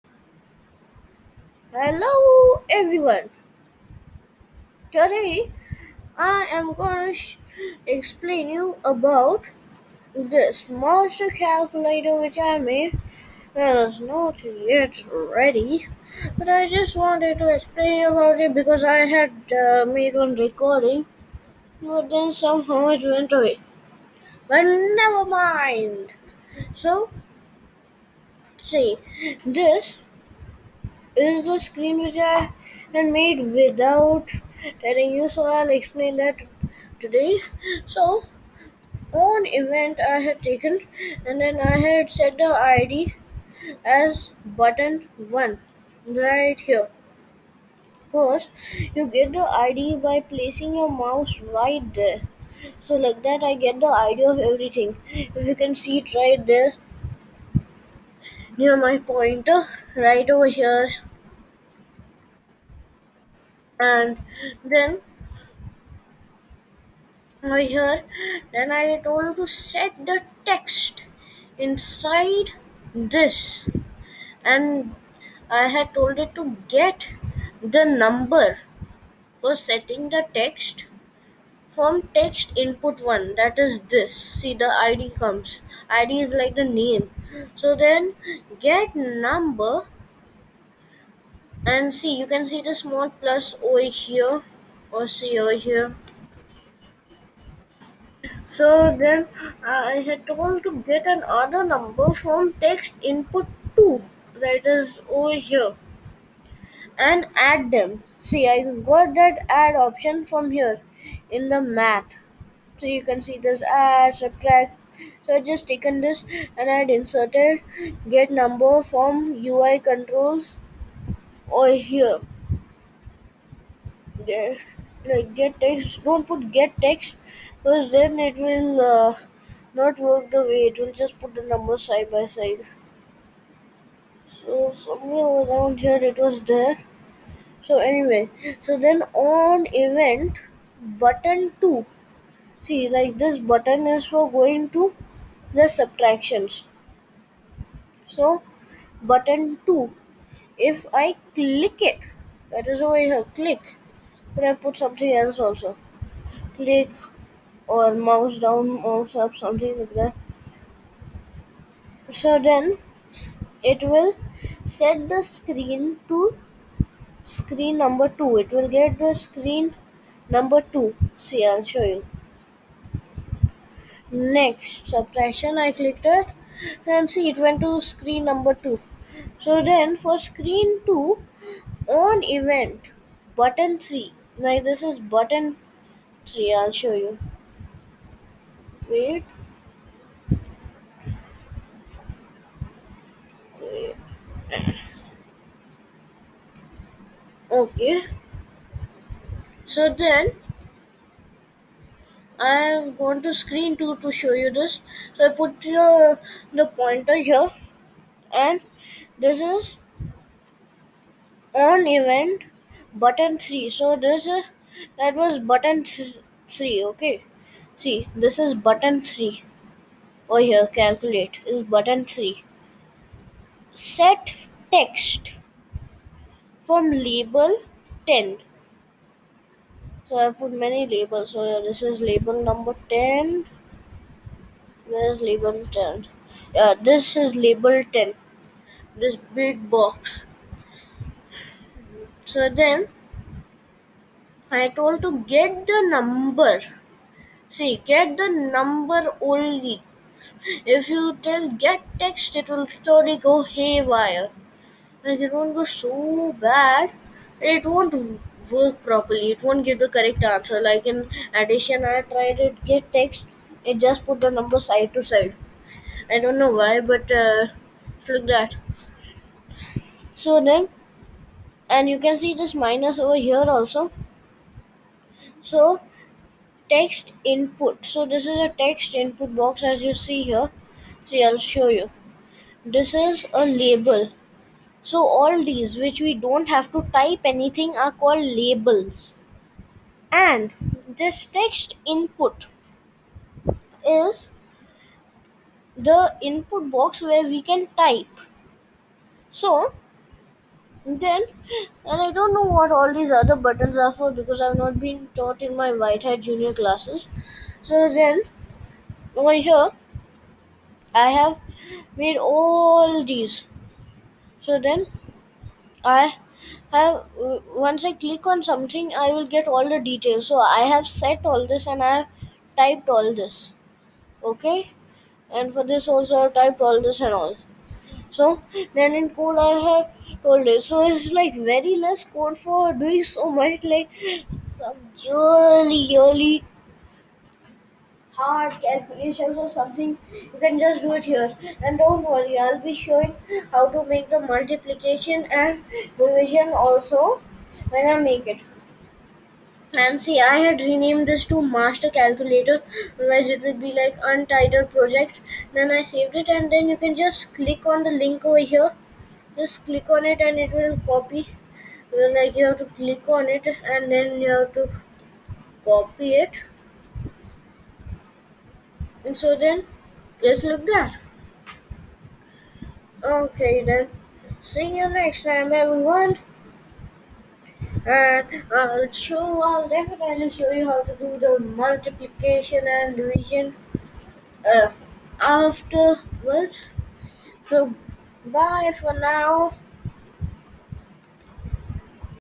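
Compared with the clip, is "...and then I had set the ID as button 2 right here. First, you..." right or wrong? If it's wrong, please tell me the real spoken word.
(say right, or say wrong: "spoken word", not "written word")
wrong: "1", not "2".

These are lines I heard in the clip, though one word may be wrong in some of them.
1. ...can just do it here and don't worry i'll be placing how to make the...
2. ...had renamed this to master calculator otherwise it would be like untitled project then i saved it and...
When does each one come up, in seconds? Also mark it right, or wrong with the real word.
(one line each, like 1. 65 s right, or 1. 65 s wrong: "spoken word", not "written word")
1. 340 s wrong: "showing", not "placing"
2. 350 s right.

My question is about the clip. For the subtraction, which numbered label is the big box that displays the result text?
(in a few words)
label 10.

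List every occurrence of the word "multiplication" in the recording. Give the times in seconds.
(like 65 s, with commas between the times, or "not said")
344 s, 381 s.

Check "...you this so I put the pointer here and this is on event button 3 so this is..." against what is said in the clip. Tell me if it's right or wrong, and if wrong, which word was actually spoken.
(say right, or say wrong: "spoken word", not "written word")
right.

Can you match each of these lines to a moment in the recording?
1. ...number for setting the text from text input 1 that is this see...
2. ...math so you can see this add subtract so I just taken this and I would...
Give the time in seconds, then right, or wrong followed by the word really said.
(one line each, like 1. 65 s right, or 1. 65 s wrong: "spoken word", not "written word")
1. 77 s right
2. 111 s right.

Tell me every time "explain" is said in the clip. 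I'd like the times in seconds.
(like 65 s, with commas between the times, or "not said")
7 s, 17 s, 35 s.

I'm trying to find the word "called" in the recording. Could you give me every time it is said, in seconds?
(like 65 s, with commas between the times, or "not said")
287 s.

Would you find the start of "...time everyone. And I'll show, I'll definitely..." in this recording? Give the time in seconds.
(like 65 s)
375 s.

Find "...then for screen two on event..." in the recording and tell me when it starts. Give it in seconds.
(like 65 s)
179 s.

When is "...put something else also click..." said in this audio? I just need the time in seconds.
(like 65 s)
154 s.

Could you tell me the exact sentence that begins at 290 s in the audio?
And this text input is the input box where we can type.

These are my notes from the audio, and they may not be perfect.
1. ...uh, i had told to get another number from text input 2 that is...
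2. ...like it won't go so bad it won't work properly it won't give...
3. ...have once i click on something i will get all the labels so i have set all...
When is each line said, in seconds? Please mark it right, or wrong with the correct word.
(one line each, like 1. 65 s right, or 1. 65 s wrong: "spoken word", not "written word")
1. 99 s right
2. 255 s right
3. 316 s wrong: "details", not "labels".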